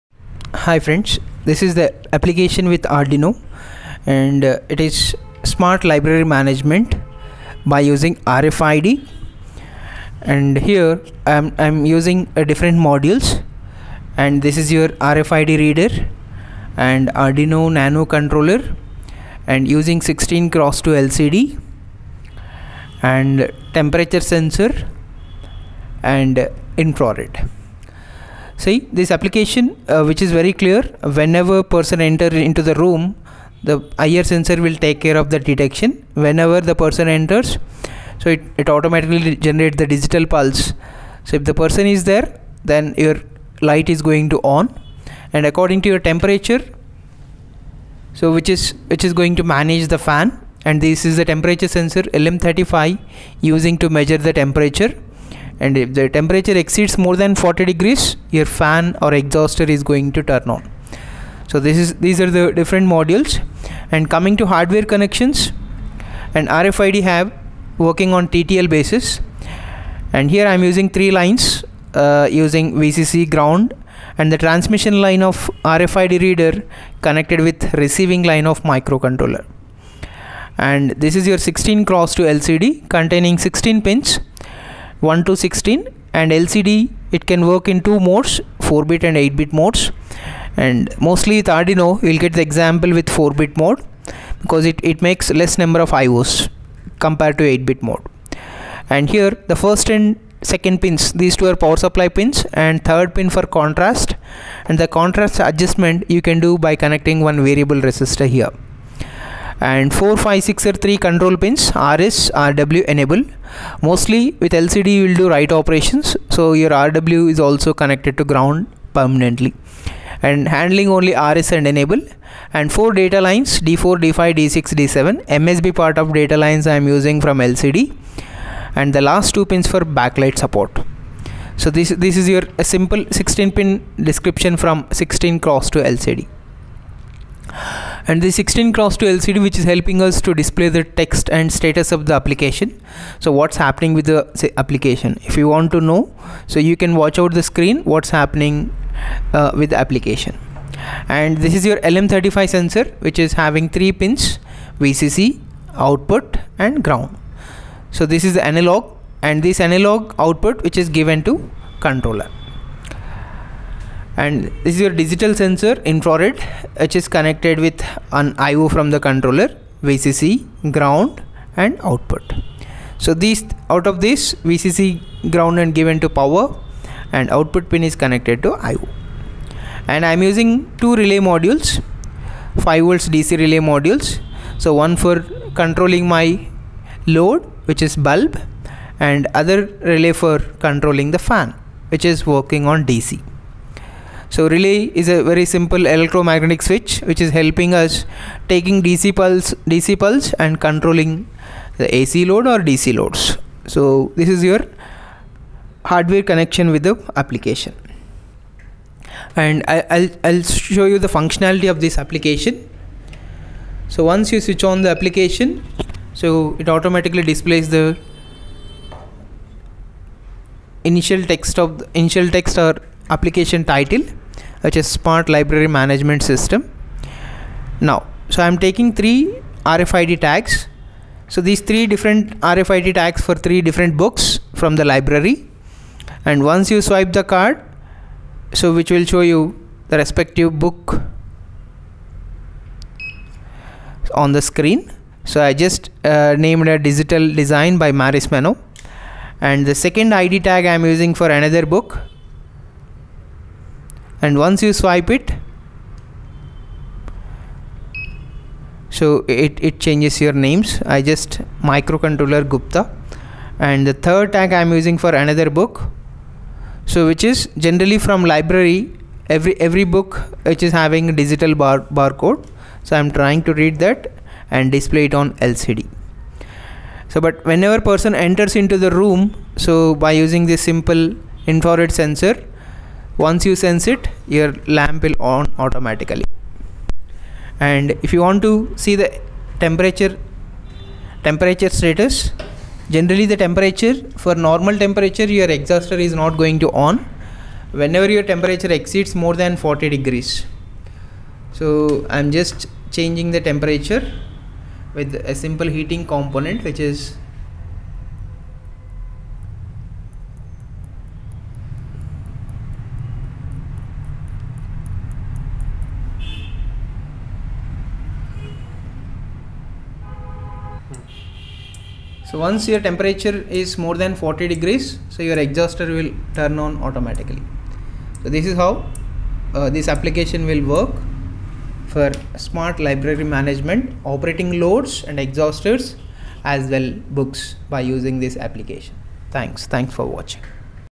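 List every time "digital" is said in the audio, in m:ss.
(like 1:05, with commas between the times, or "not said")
0:39, 2:44, 4:06, 4:31.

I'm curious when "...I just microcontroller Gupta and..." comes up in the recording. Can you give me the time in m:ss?
4:20.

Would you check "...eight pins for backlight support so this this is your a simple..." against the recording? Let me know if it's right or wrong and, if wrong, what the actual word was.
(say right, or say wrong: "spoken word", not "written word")
wrong: "two", not "eight".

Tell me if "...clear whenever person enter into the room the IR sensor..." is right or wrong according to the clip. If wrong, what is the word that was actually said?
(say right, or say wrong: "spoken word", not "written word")
right.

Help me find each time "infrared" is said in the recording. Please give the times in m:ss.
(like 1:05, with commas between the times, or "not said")
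0:26, 2:45, 4:41.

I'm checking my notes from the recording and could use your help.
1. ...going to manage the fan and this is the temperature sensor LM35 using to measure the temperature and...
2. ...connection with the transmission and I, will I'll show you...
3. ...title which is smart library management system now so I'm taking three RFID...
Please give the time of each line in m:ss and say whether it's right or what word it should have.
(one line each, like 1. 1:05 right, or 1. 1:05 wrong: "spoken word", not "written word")
1. 0:49 right
2. 3:26 wrong: "application", not "transmission"
3. 3:43 right.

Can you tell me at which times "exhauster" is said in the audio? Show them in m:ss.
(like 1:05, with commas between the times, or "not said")
0:59, 4:55, 5:25, 5:35.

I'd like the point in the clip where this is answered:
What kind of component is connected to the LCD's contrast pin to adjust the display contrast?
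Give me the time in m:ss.
1:47.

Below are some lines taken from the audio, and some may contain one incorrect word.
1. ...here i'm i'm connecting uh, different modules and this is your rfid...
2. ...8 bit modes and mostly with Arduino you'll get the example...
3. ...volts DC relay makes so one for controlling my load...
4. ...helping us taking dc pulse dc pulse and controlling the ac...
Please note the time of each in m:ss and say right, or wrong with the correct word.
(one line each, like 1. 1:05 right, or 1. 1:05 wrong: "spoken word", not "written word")
1. 0:10 wrong: "using", not "connecting"
2. 1:29 right
3. 3:02 wrong: "modules", not "makes"
4. 3:17 right.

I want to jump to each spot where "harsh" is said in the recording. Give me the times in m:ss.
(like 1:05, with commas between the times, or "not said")
not said.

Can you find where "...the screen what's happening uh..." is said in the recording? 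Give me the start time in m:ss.
2:27.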